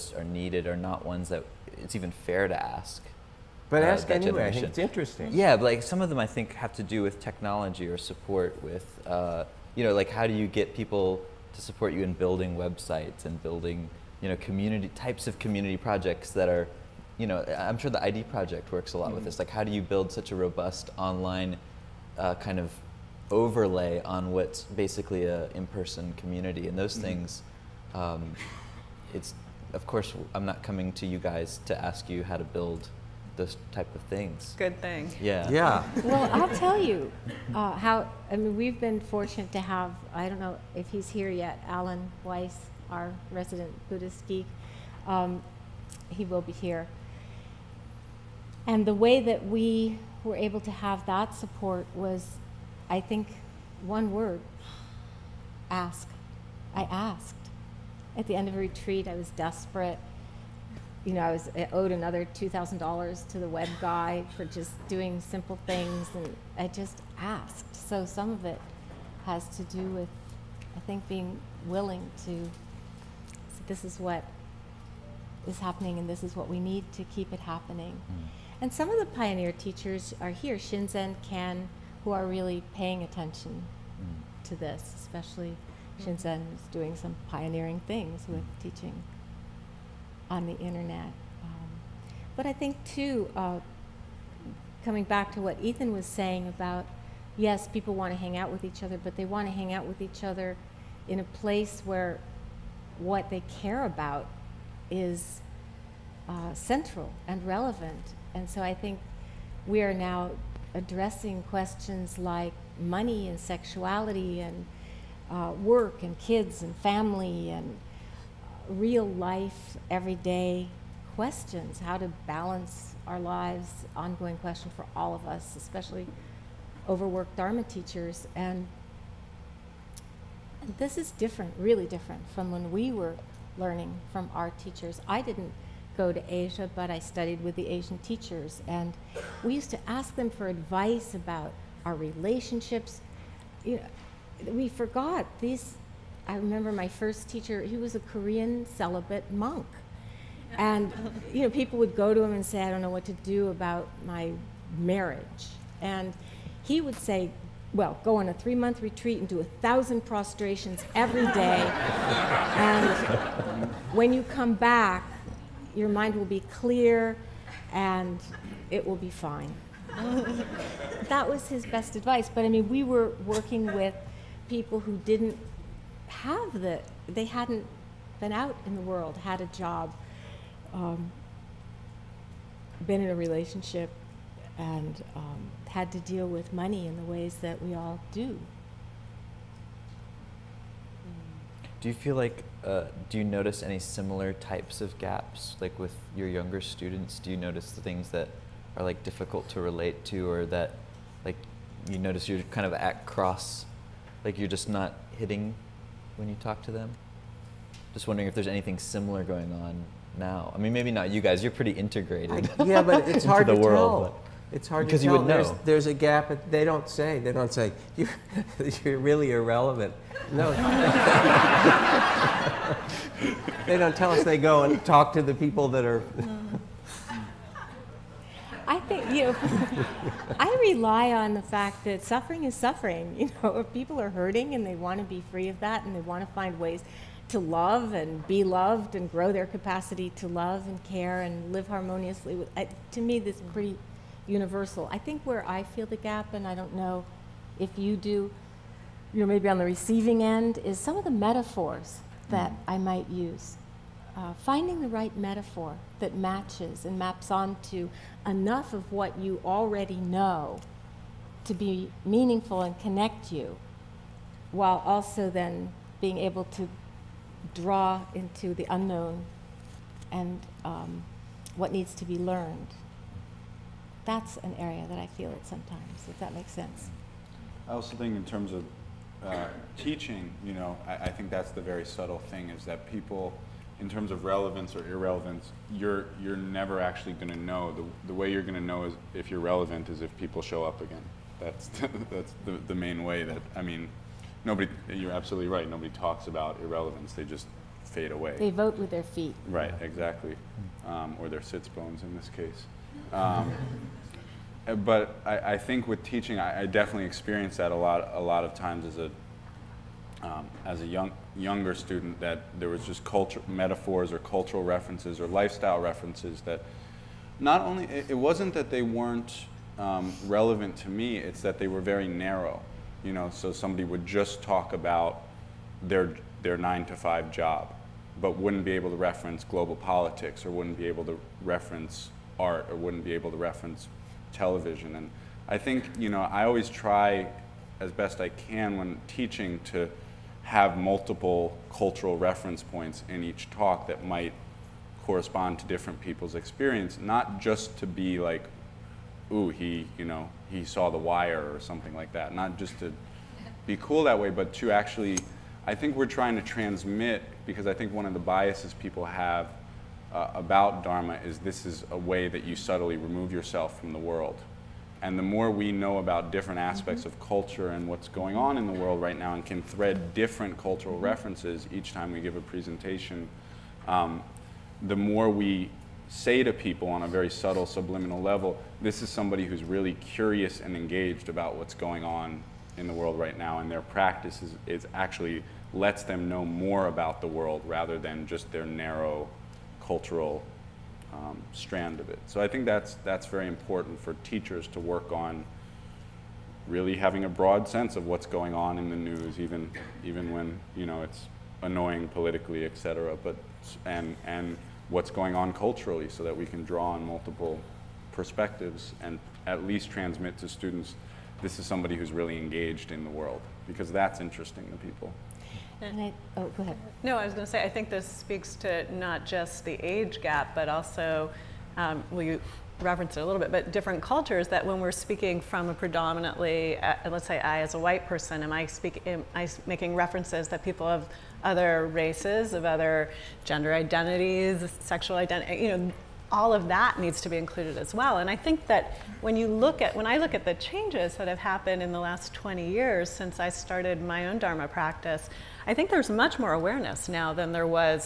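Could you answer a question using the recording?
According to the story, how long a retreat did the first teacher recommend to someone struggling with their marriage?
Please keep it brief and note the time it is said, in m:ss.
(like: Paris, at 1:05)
three month, at 2:38.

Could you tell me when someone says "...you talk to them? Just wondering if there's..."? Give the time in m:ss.
3:26.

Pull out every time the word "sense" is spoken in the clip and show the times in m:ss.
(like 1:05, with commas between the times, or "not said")
4:36, 6:37.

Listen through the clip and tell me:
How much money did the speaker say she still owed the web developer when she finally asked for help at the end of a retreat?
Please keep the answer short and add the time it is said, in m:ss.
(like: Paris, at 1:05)
$2,000, at 1:02.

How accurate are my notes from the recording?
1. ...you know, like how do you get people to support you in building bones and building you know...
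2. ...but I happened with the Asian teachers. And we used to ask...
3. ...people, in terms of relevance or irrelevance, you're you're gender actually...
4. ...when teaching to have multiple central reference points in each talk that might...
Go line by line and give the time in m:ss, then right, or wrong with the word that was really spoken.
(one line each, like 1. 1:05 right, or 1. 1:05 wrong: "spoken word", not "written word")
1. 0:09 wrong: "websites", not "bones"
2. 2:16 wrong: "studied", not "happened"
3. 4:42 wrong: "never", not "gender"
4. 5:38 wrong: "cultural", not "central".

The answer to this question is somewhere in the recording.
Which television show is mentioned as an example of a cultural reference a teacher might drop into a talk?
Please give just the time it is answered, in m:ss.
5:50.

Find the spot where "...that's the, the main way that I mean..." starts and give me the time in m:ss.
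4:52.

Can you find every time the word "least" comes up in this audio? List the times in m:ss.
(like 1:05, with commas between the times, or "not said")
6:49.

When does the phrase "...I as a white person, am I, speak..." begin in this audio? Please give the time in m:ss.
7:07.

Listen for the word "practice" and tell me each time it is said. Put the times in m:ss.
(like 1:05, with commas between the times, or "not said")
6:23, 7:24.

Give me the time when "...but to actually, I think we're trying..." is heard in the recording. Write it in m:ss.
5:54.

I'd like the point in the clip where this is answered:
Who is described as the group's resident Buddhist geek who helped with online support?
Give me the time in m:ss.
0:41.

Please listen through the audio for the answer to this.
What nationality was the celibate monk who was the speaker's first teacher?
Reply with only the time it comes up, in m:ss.
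2:27.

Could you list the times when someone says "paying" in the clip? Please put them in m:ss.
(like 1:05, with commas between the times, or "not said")
1:22.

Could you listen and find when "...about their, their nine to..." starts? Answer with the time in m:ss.
5:24.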